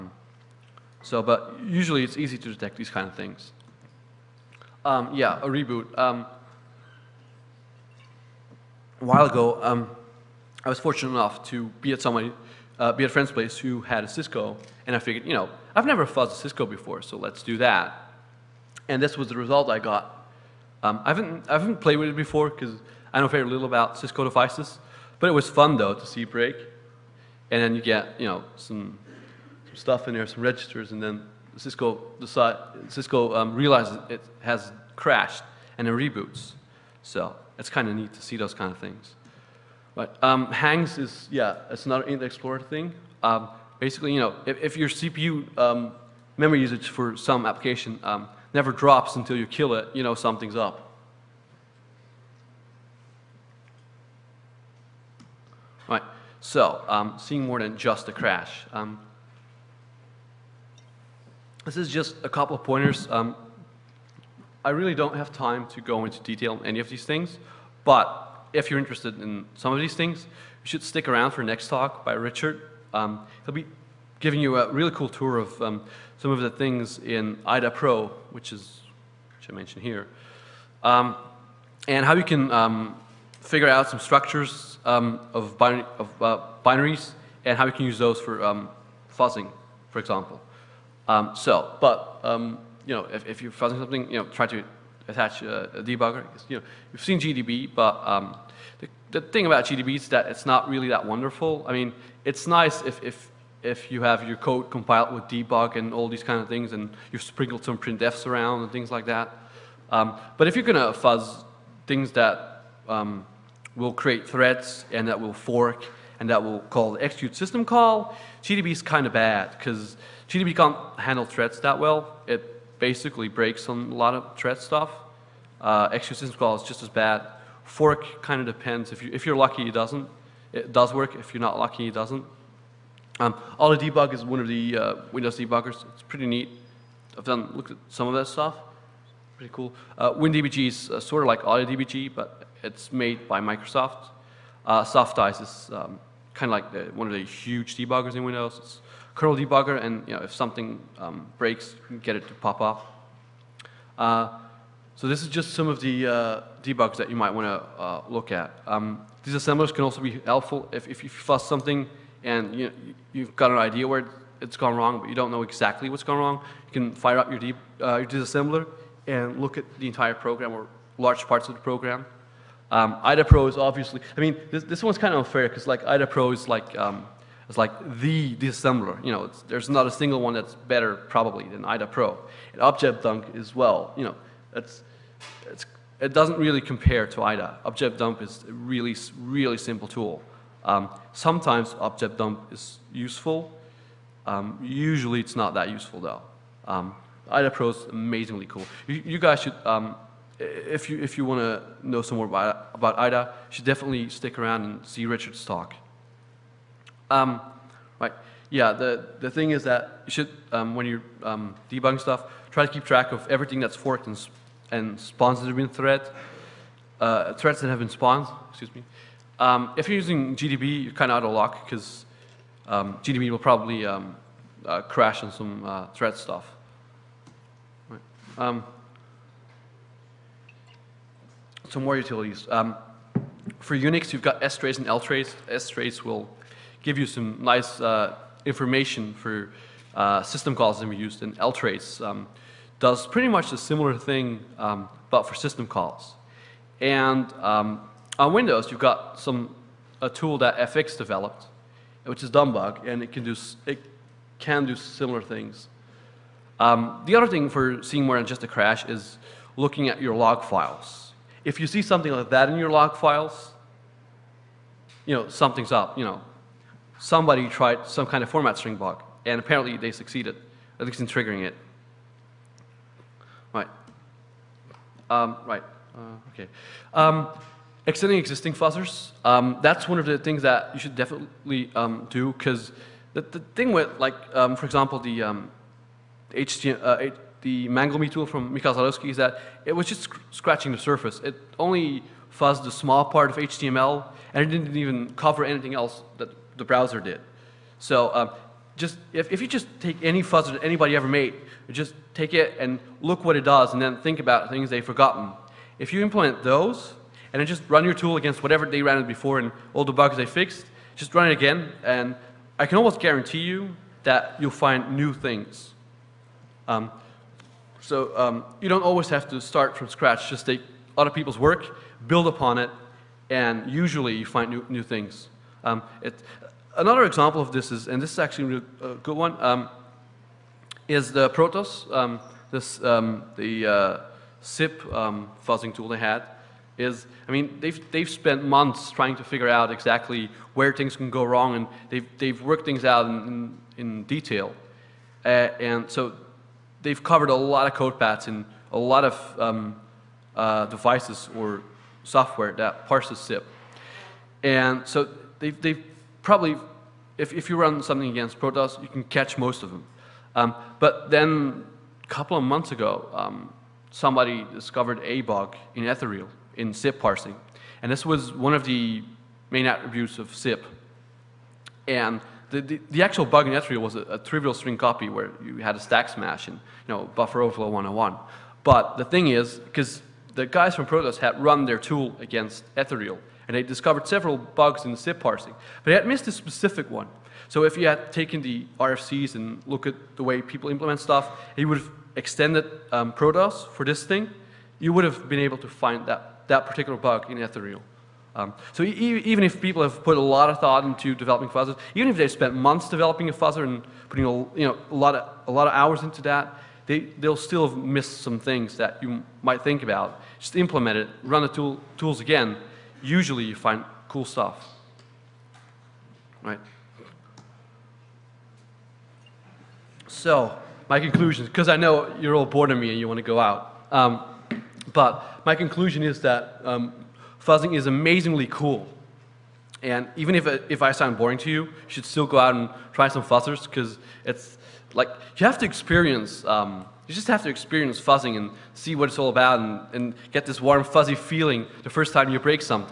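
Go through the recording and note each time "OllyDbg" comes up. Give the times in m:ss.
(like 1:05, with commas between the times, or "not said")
2:21.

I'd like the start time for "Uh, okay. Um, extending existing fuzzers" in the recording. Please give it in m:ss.
4:35.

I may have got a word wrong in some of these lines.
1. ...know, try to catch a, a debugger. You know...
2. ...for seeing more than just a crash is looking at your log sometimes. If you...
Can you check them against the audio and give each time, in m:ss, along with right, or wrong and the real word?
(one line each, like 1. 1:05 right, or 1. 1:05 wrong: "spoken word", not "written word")
1. 1:34 wrong: "attach", not "catch"
2. 4:17 wrong: "files", not "sometimes".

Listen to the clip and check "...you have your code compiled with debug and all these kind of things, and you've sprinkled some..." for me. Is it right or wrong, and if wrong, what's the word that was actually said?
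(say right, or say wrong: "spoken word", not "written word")
right.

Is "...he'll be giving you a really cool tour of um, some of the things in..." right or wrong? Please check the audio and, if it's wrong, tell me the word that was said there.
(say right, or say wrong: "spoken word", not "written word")
right.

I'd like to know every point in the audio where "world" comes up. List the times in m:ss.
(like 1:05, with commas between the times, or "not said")
not said.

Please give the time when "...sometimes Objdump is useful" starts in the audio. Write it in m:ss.
3:11.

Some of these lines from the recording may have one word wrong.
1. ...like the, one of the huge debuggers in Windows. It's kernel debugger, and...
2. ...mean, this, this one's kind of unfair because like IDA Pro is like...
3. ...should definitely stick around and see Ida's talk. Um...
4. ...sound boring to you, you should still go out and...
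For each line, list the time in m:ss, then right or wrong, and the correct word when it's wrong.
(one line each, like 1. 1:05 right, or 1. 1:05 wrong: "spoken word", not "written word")
1. 2:26 right
2. 2:54 right
3. 3:23 wrong: "Richard", not "Ida"
4. 7:10 right.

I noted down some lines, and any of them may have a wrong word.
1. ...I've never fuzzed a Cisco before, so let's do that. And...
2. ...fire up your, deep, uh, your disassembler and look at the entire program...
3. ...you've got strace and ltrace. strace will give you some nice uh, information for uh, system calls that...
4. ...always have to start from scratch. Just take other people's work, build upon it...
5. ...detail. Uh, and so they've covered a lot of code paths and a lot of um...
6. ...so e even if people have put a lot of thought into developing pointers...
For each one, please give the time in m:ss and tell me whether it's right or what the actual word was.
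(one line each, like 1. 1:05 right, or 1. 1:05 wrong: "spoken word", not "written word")
1. 0:15 right
2. 2:46 right
3. 3:54 right
4. 5:18 right
5. 5:44 right
6. 6:38 wrong: "fuzzers", not "pointers".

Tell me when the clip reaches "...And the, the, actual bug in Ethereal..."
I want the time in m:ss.
6:11.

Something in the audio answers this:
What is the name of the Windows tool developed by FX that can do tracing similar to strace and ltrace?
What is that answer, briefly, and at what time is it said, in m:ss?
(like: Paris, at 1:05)
DumbBug, at 4:12.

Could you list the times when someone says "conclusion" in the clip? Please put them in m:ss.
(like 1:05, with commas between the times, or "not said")
7:00, 7:05.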